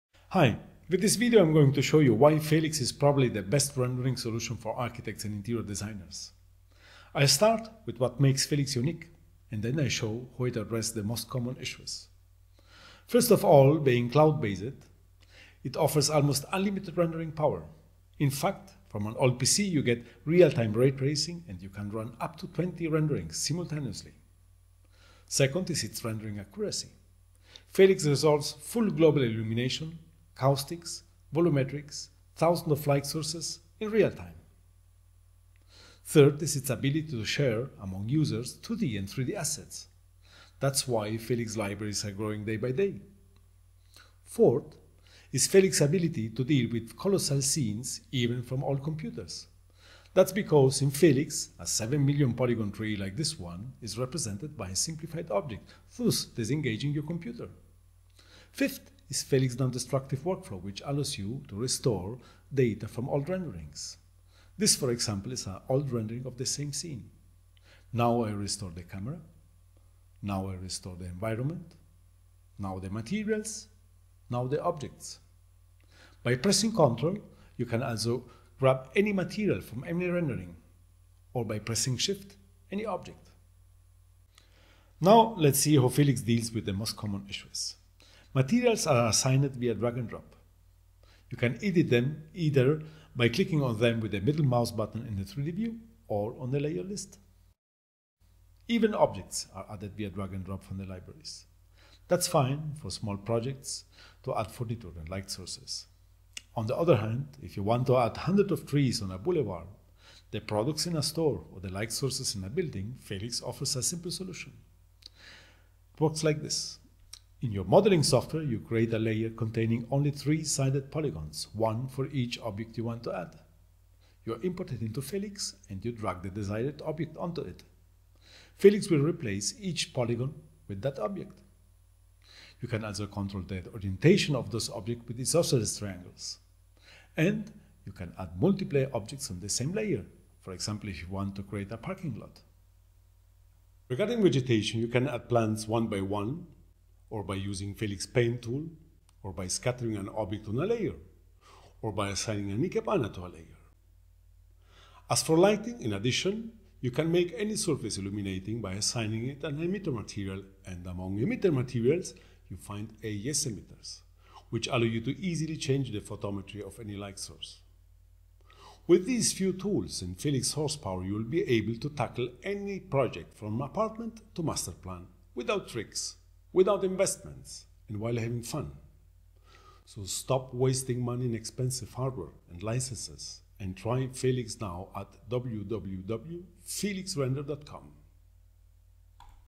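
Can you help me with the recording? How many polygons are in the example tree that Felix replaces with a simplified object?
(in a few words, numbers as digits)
7 million.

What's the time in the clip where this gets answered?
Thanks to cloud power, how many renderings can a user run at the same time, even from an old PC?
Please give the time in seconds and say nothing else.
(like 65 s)
22 s.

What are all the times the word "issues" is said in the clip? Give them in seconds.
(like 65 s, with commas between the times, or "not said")
11 s, 87 s.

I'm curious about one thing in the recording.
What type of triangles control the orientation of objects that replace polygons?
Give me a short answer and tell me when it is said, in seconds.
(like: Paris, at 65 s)
isosceles triangles, at 135 s.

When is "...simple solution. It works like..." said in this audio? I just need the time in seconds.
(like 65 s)
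113 s.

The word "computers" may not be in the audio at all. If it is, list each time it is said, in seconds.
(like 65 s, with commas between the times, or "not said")
48 s, 57 s.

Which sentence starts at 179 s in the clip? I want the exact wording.
So stop wasting money in expensive hardware and licenses and try Felix now at www.felixrender.com.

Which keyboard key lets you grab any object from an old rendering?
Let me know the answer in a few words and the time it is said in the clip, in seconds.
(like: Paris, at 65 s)
Shift, at 81 s.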